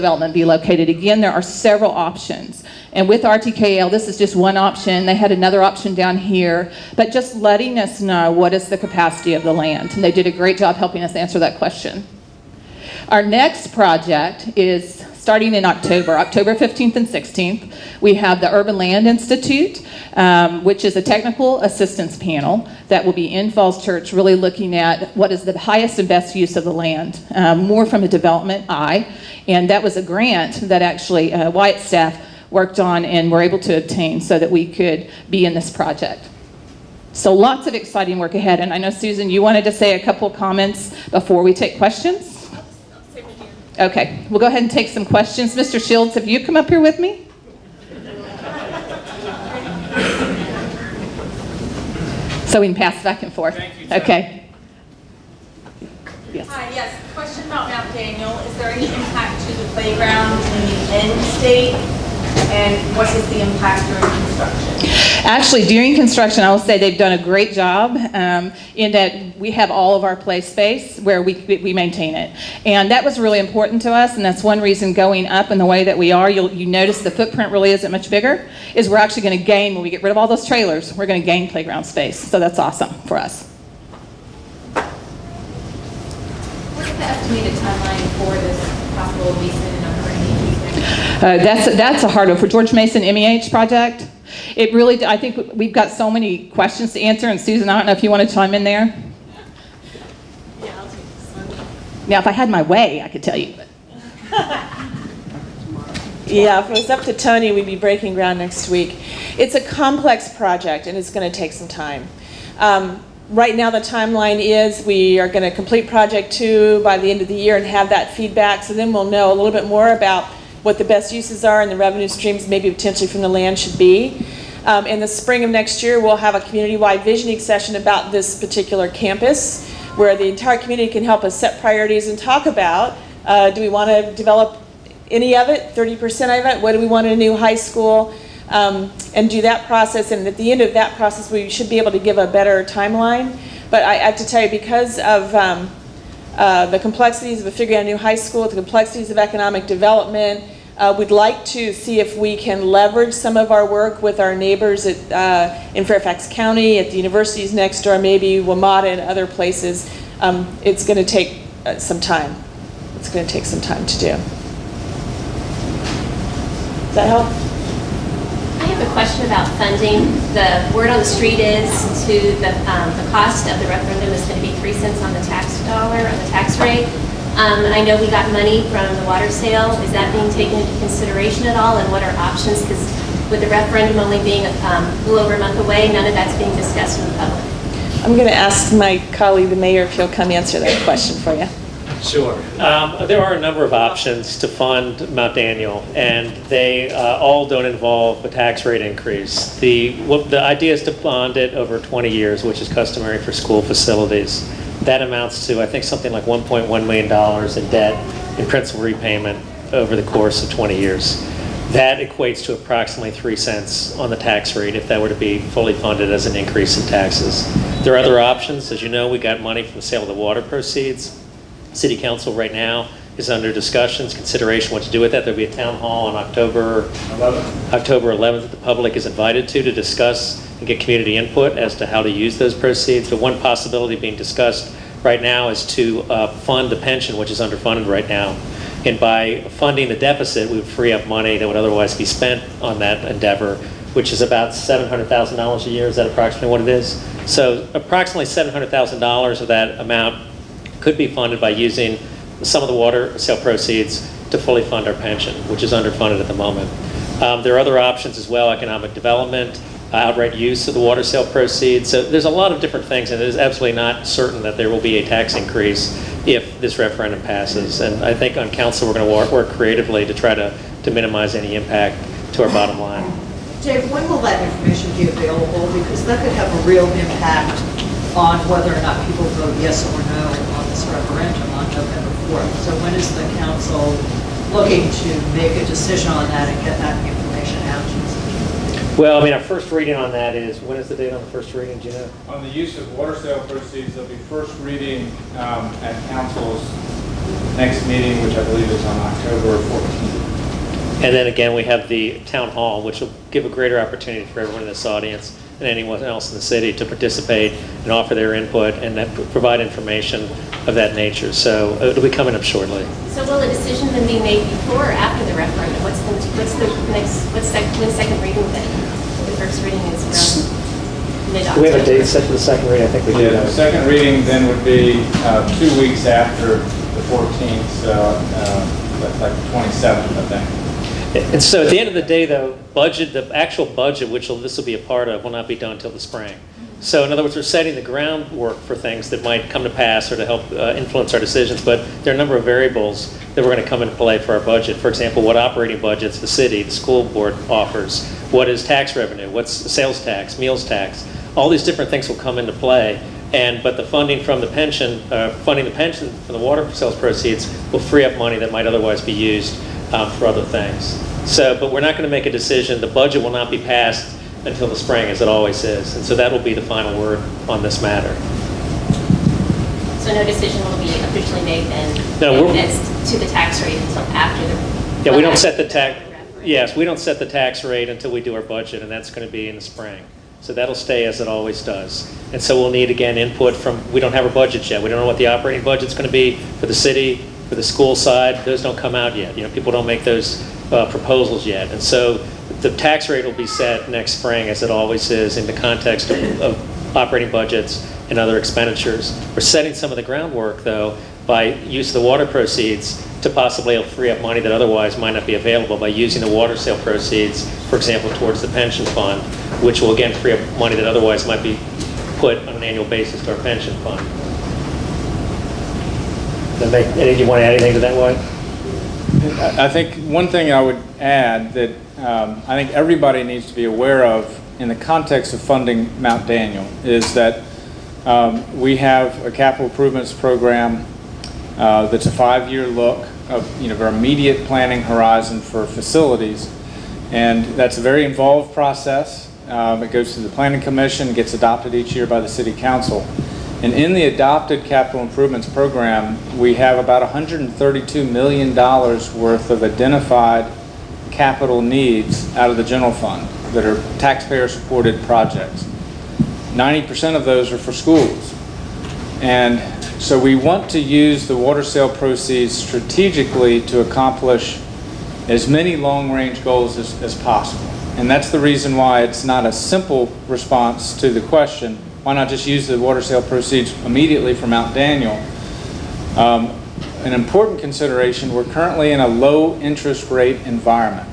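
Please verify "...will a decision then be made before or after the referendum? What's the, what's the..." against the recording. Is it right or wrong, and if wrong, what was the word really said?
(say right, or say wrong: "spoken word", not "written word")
right.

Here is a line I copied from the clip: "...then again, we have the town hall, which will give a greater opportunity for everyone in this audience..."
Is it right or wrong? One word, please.
right.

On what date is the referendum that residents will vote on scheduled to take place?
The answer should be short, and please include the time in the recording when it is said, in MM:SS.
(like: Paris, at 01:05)
November 4, at 04:41.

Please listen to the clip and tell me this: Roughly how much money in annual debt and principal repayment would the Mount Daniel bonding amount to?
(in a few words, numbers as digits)
$1.1 million.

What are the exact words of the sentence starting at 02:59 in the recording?
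Is that being taken into consideration at all, and what are options?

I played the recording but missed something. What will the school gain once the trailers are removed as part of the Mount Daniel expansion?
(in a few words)
playground space.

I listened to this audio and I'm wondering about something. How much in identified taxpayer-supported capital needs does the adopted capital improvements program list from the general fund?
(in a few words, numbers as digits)
$132 million.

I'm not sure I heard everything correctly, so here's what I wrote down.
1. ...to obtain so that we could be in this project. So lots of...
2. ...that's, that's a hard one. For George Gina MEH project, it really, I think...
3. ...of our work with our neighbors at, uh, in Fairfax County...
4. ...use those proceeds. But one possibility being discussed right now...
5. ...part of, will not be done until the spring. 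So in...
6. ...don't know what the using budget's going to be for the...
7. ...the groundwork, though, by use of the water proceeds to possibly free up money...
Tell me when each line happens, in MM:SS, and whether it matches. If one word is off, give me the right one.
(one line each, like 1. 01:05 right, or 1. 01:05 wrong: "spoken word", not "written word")
1. 00:33 right
2. 01:31 wrong: "Mason", not "Gina"
3. 02:33 right
4. 03:52 right
5. 05:34 right
6. 06:24 wrong: "operating", not "using"
7. 06:39 right.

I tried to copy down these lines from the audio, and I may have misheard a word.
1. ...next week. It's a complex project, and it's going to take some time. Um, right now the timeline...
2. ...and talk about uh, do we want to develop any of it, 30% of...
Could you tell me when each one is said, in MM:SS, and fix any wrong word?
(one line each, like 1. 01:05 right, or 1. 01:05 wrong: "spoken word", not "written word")
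1. 01:48 right
2. 02:12 right.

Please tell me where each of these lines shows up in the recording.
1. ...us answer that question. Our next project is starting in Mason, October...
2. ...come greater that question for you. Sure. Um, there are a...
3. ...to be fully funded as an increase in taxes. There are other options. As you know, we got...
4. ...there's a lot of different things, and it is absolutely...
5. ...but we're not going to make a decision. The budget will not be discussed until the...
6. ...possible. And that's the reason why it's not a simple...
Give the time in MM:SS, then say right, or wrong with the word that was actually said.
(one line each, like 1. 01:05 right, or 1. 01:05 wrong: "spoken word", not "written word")
1. 00:11 wrong: "October", not "Mason"
2. 03:10 wrong: "answer", not "greater"
3. 03:35 right
4. 04:22 right
5. 06:01 wrong: "passed", not "discussed"
6. 07:47 right.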